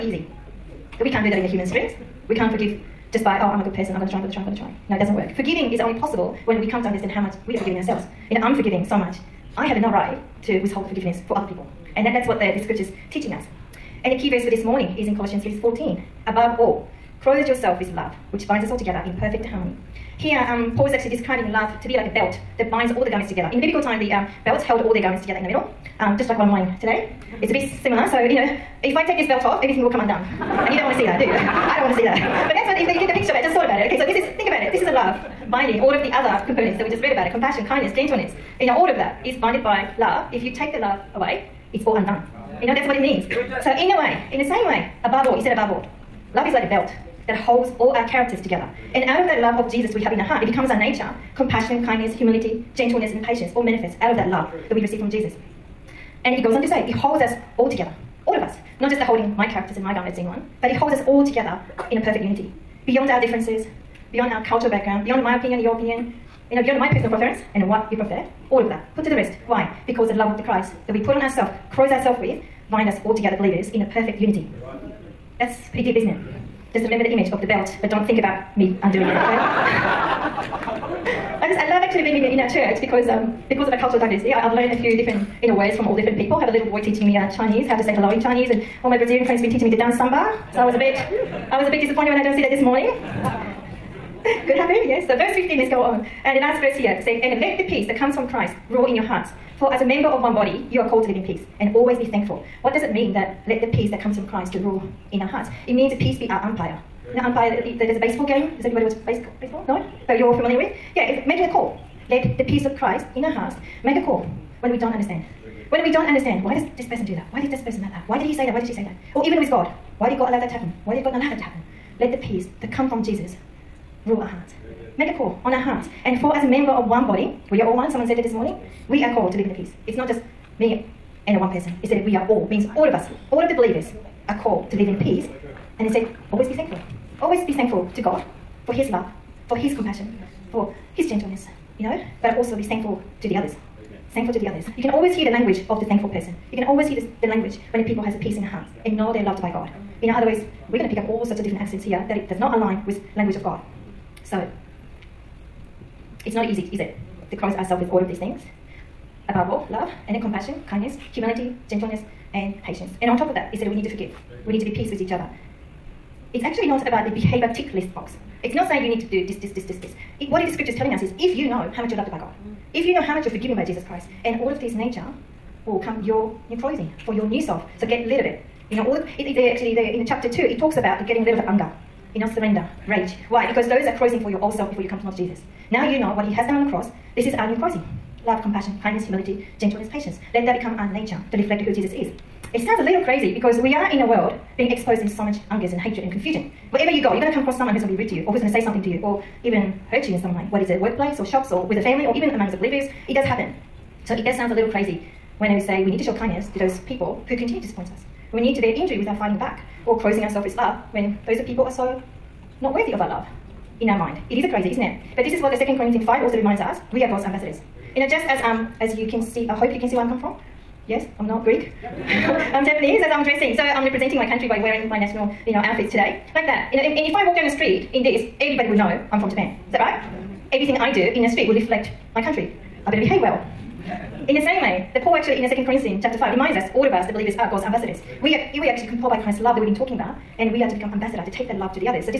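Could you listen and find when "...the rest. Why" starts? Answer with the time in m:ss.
1:09.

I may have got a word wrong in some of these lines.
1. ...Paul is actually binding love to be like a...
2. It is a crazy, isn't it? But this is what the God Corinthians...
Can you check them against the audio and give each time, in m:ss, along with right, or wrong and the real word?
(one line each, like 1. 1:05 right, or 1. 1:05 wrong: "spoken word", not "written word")
1. 0:20 wrong: "describing", not "binding"
2. 3:34 wrong: "Second", not "God".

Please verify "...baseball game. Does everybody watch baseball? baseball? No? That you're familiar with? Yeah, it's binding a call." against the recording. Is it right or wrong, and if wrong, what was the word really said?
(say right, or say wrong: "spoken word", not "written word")
wrong: "making", not "binding".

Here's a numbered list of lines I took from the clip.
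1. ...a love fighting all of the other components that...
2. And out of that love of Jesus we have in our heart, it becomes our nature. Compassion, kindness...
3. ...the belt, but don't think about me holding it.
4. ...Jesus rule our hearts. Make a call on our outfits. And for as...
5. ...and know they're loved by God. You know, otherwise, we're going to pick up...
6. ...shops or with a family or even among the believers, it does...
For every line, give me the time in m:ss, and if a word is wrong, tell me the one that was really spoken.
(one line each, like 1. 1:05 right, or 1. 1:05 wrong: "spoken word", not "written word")
1. 0:34 wrong: "binding", not "fighting"
2. 0:48 right
3. 1:17 wrong: "undoing", not "holding"
4. 2:03 wrong: "hearts", not "outfits"
5. 2:28 right
6. 3:21 right.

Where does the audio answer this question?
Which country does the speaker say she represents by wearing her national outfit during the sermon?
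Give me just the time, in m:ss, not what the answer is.
3:49.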